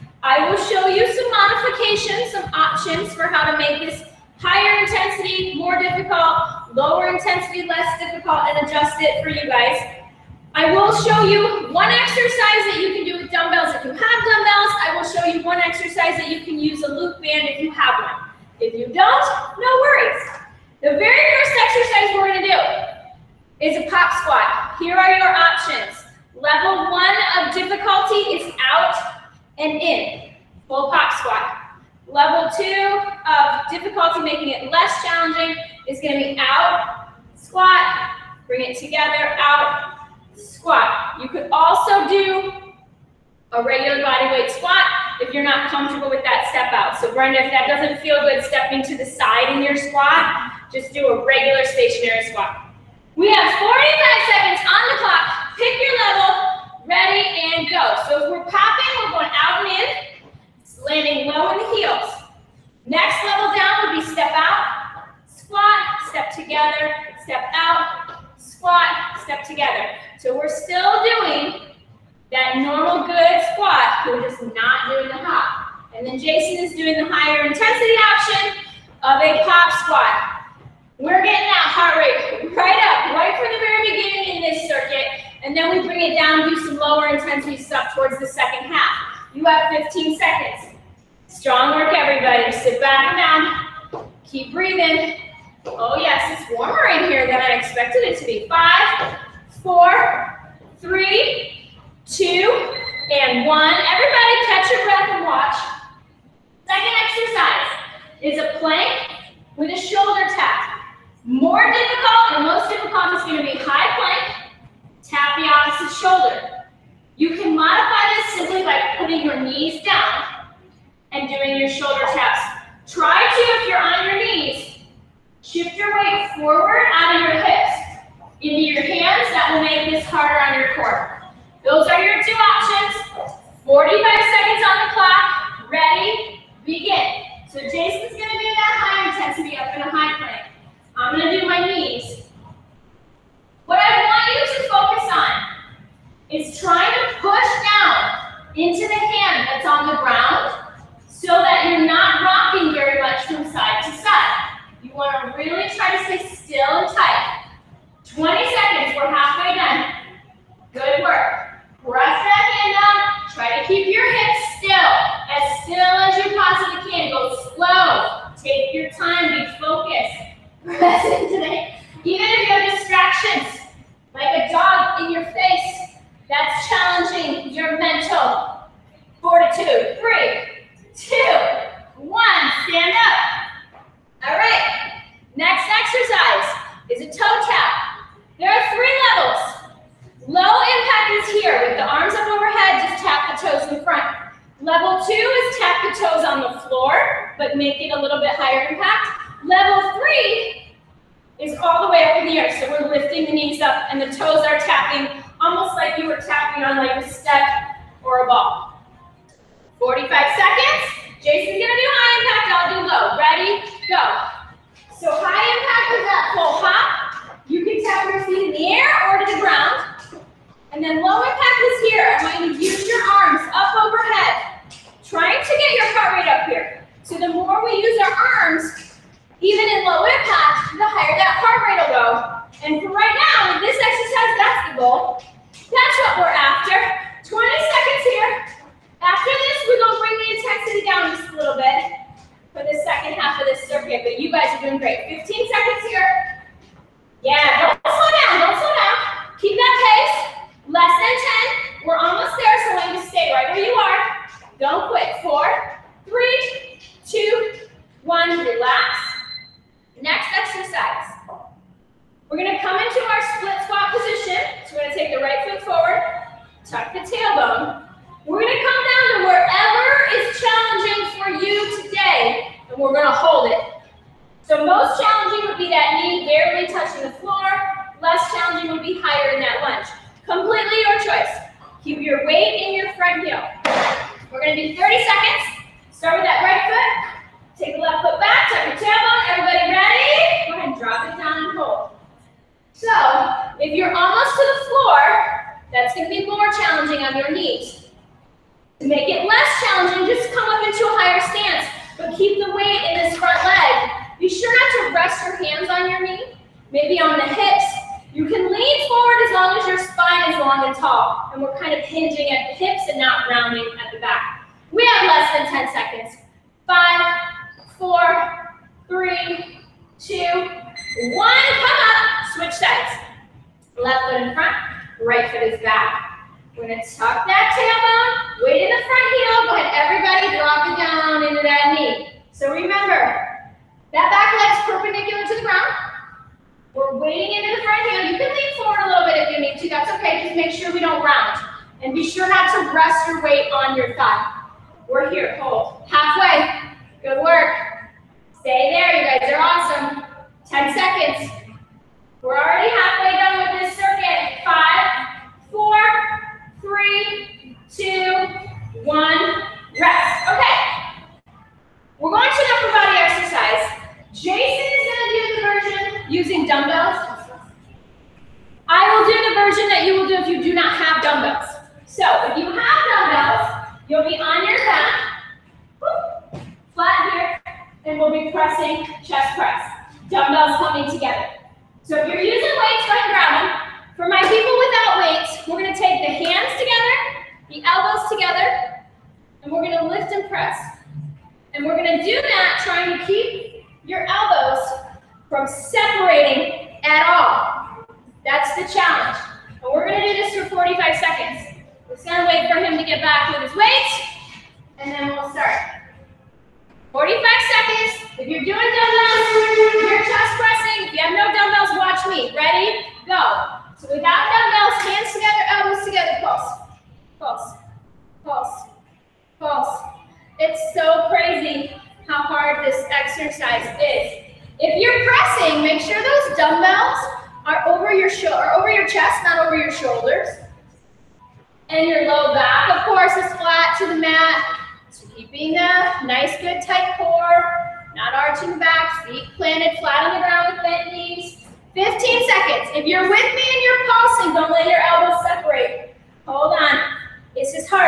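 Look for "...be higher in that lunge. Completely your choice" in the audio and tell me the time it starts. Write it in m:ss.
4:38.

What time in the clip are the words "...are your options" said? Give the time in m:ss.
0:24.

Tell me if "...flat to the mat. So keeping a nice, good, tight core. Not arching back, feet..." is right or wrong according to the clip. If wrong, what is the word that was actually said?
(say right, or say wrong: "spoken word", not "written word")
right.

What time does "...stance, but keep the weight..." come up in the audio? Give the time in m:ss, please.
5:01.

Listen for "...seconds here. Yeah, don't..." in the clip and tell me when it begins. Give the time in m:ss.
4:05.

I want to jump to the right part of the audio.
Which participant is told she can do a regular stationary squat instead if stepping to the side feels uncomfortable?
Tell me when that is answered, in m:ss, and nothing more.
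0:47.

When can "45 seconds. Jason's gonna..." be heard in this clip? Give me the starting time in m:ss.
3:29.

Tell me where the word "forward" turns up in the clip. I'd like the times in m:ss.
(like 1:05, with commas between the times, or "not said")
2:06, 4:25, 5:08, 5:38.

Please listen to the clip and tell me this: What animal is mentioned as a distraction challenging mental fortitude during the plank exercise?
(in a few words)
Dog.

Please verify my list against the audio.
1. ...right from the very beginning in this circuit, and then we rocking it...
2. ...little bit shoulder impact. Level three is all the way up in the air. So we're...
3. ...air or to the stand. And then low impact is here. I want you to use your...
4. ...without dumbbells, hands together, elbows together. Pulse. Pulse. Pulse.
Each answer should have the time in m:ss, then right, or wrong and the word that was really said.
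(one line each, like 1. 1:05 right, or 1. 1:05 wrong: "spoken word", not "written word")
1. 1:23 wrong: "bring", not "rocking"
2. 3:18 wrong: "higher", not "shoulder"
3. 3:38 wrong: "ground", not "stand"
4. 6:53 right.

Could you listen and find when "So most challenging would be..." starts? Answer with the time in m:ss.
4:34.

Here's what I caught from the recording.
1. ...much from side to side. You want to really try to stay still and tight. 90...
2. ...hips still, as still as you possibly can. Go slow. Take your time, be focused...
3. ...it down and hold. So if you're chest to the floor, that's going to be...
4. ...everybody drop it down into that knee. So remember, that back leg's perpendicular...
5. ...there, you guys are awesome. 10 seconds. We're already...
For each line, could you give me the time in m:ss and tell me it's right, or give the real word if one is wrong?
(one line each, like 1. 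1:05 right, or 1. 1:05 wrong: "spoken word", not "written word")
1. 2:33 wrong: "20", not "90"
2. 2:44 right
3. 4:51 wrong: "almost", not "chest"
4. 5:29 right
5. 5:48 right.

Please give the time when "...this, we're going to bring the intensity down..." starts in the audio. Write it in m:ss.
3:59.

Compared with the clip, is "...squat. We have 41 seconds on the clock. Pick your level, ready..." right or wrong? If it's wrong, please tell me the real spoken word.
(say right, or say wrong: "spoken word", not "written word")
wrong: "45", not "41".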